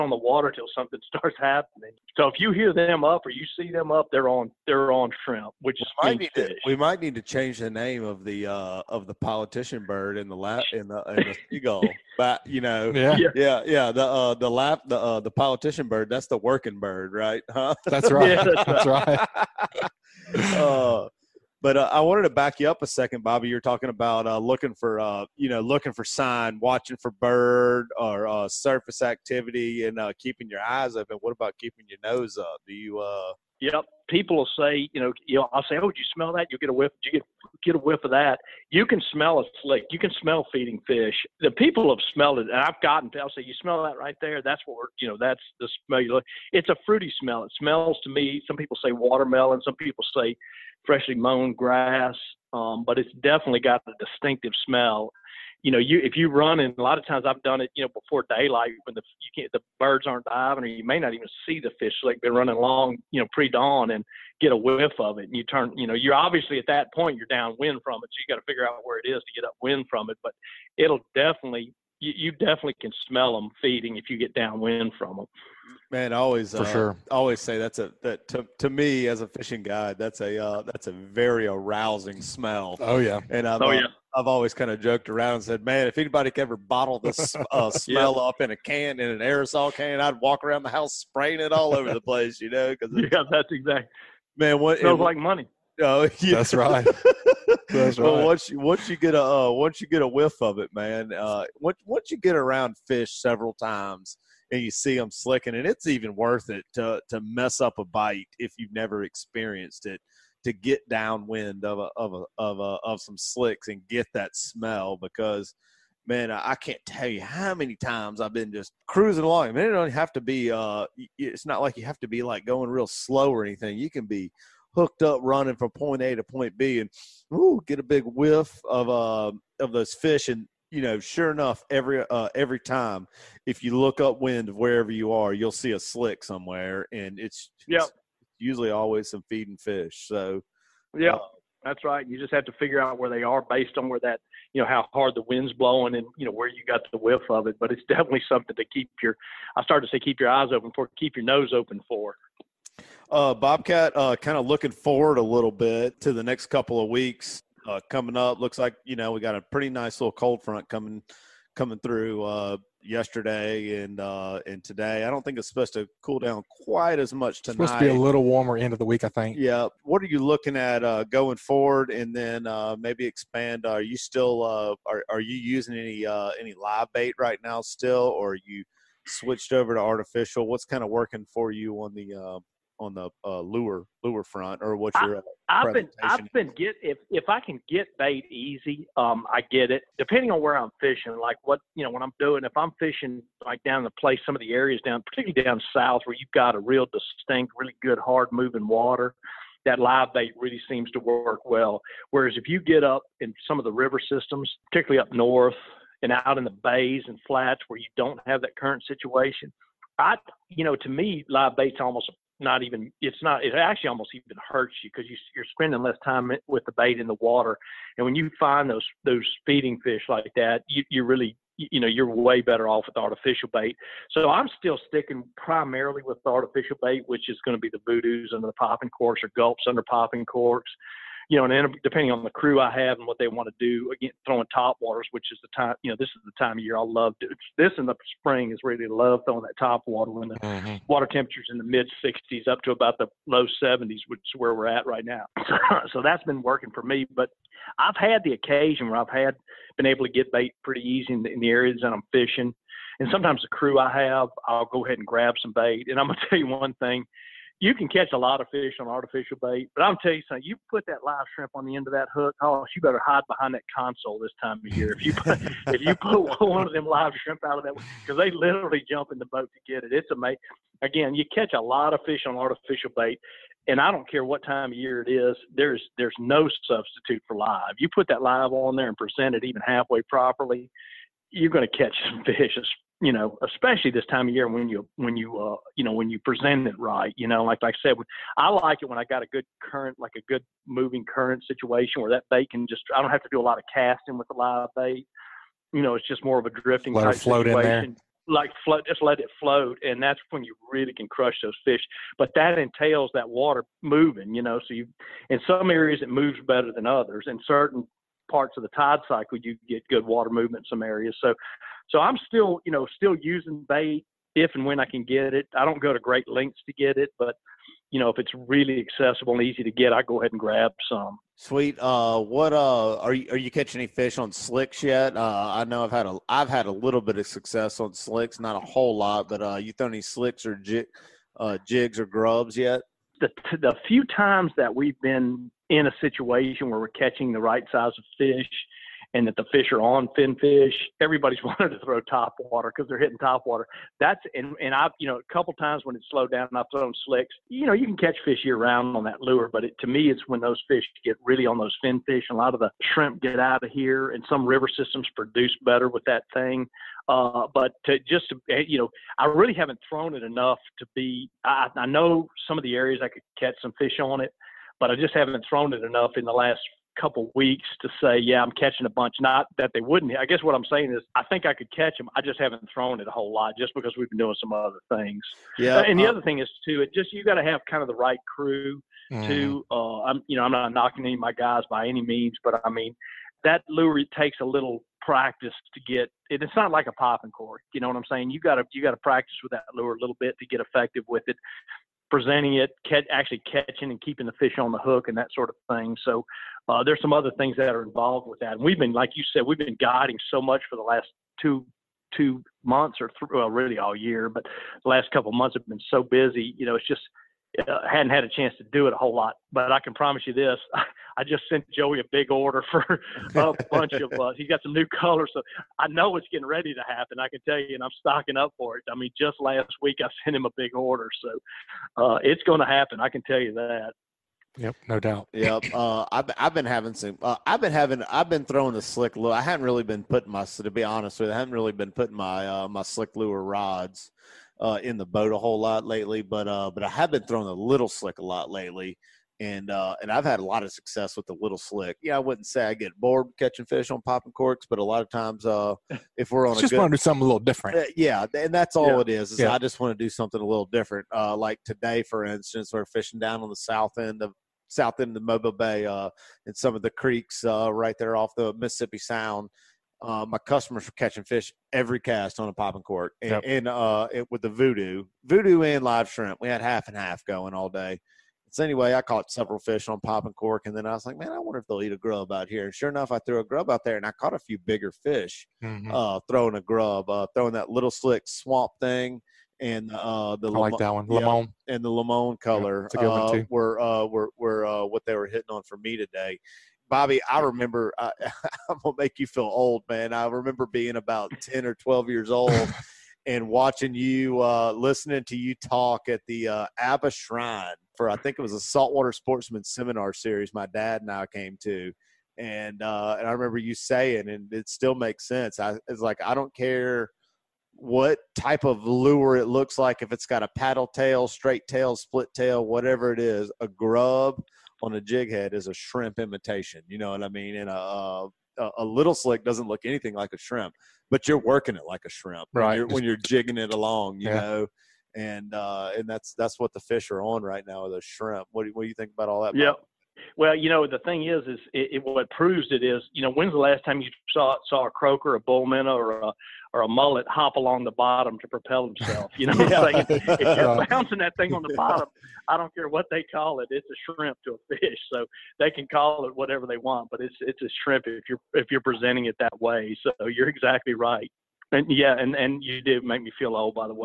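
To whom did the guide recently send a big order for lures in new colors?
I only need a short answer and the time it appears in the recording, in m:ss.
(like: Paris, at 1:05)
Joey, at 6:51.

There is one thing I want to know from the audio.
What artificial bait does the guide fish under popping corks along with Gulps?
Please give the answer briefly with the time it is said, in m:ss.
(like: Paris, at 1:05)
voodoos, at 3:47.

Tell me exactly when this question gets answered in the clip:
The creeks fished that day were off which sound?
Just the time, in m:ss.
7:38.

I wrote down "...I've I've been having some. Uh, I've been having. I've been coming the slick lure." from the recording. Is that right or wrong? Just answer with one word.
wrong.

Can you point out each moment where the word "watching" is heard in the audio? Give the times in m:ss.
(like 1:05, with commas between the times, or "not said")
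0:26, 8:13.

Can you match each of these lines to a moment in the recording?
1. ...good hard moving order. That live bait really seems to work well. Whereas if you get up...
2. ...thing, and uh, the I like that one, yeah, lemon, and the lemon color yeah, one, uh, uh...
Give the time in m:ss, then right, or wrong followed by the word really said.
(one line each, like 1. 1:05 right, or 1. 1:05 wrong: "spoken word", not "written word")
1. 3:17 wrong: "water", not "order"
2. 7:58 right.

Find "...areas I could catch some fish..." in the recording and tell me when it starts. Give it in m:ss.
6:02.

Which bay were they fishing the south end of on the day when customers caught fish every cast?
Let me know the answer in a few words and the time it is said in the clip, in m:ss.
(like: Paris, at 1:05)
Mobile Bay, at 7:35.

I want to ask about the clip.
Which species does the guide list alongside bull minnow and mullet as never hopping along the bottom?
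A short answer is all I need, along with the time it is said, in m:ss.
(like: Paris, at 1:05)
croaker, at 8:54.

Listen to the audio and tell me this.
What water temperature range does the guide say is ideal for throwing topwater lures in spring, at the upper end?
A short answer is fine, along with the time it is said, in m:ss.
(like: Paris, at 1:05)
low 70s, at 4:03.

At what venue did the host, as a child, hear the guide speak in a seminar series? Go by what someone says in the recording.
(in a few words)
Abba Shrine.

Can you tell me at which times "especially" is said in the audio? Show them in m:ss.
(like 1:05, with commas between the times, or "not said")
4:43.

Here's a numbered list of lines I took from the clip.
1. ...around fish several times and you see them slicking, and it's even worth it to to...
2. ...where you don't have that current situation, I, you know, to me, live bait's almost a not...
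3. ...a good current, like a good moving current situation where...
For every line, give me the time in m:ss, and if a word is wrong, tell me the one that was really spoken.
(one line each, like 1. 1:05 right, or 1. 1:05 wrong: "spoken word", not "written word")
1. 1:42 right
2. 3:27 right
3. 4:49 right.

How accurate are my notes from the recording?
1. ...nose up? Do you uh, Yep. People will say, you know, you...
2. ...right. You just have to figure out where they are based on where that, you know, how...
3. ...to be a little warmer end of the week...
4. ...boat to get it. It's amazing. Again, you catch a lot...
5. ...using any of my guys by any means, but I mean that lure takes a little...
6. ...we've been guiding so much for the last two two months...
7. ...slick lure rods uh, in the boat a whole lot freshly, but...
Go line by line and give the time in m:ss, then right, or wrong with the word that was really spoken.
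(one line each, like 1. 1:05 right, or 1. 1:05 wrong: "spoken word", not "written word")
1. 0:32 right
2. 2:21 right
3. 2:47 right
4. 4:29 right
5. 6:20 wrong: "knocking", not "using"
6. 6:39 right
7. 7:12 wrong: "lately", not "freshly".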